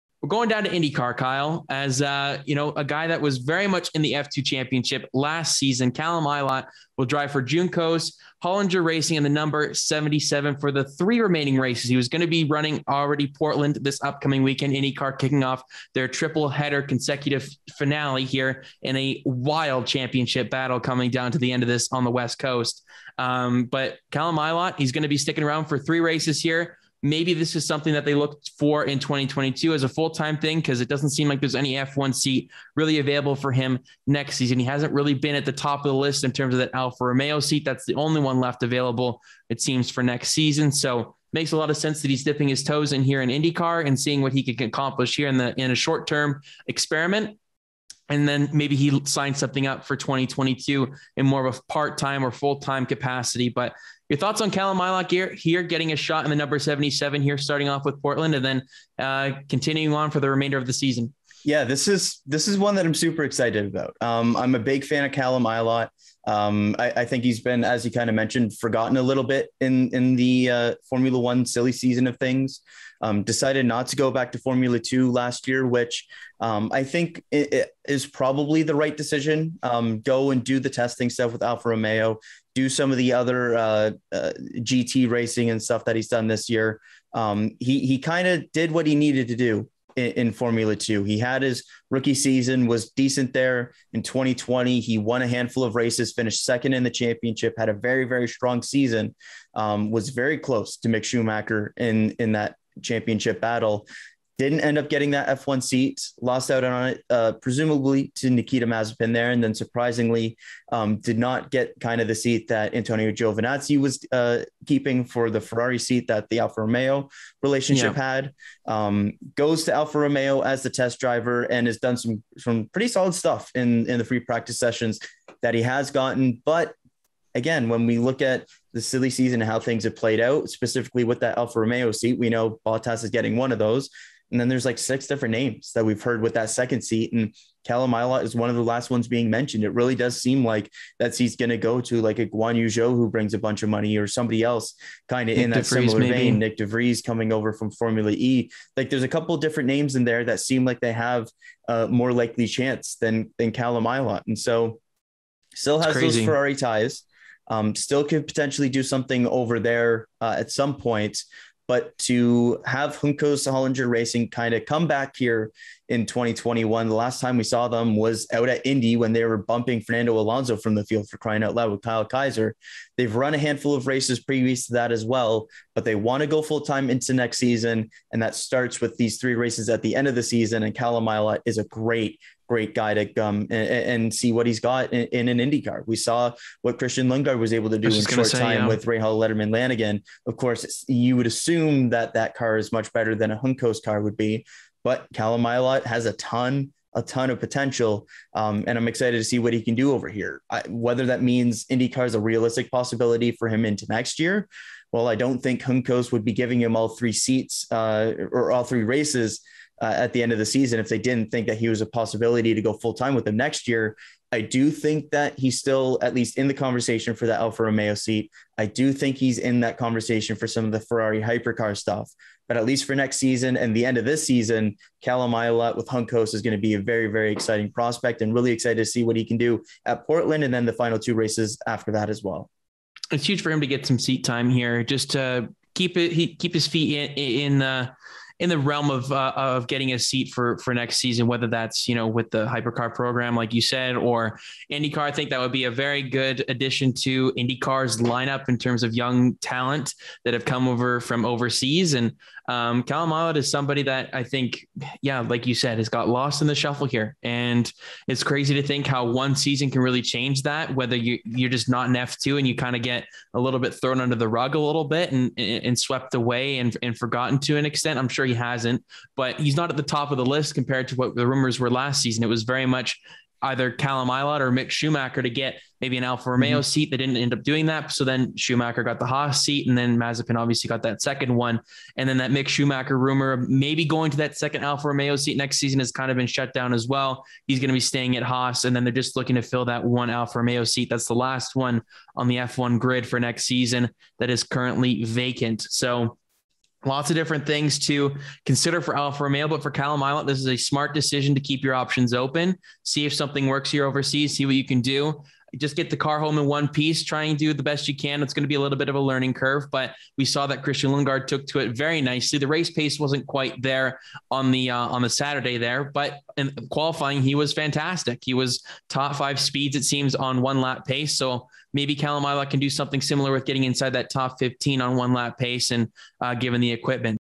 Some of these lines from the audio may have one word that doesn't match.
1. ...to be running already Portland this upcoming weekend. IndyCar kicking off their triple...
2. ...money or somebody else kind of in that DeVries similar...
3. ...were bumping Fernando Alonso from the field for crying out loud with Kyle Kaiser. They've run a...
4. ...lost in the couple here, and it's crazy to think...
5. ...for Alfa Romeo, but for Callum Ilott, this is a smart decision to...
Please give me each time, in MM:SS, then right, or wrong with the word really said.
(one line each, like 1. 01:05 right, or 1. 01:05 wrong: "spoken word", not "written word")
1. 00:12 right
2. 02:23 right
3. 02:49 right
4. 04:16 wrong: "shuffle", not "couple"
5. 04:58 right.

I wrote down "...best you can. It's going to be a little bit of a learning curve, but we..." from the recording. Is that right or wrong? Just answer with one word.
right.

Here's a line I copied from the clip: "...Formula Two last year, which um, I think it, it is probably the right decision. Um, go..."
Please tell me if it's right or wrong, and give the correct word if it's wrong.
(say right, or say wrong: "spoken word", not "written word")
right.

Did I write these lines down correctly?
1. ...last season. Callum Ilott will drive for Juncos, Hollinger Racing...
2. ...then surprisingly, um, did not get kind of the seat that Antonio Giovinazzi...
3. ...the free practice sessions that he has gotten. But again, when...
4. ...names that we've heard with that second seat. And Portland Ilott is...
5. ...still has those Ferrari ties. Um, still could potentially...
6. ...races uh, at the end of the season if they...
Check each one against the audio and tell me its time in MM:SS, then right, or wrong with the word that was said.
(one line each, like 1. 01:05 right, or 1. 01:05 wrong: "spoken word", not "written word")
1. 00:05 right
2. 01:49 right
3. 02:03 right
4. 02:15 wrong: "Callum", not "Portland"
5. 02:35 right
6. 03:28 right.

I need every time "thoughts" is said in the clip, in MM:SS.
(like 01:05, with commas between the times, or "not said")
00:54.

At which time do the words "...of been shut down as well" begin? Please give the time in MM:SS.
04:46.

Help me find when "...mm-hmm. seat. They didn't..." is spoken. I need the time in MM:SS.
04:36.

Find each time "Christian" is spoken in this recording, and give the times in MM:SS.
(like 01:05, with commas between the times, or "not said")
03:06, 05:10.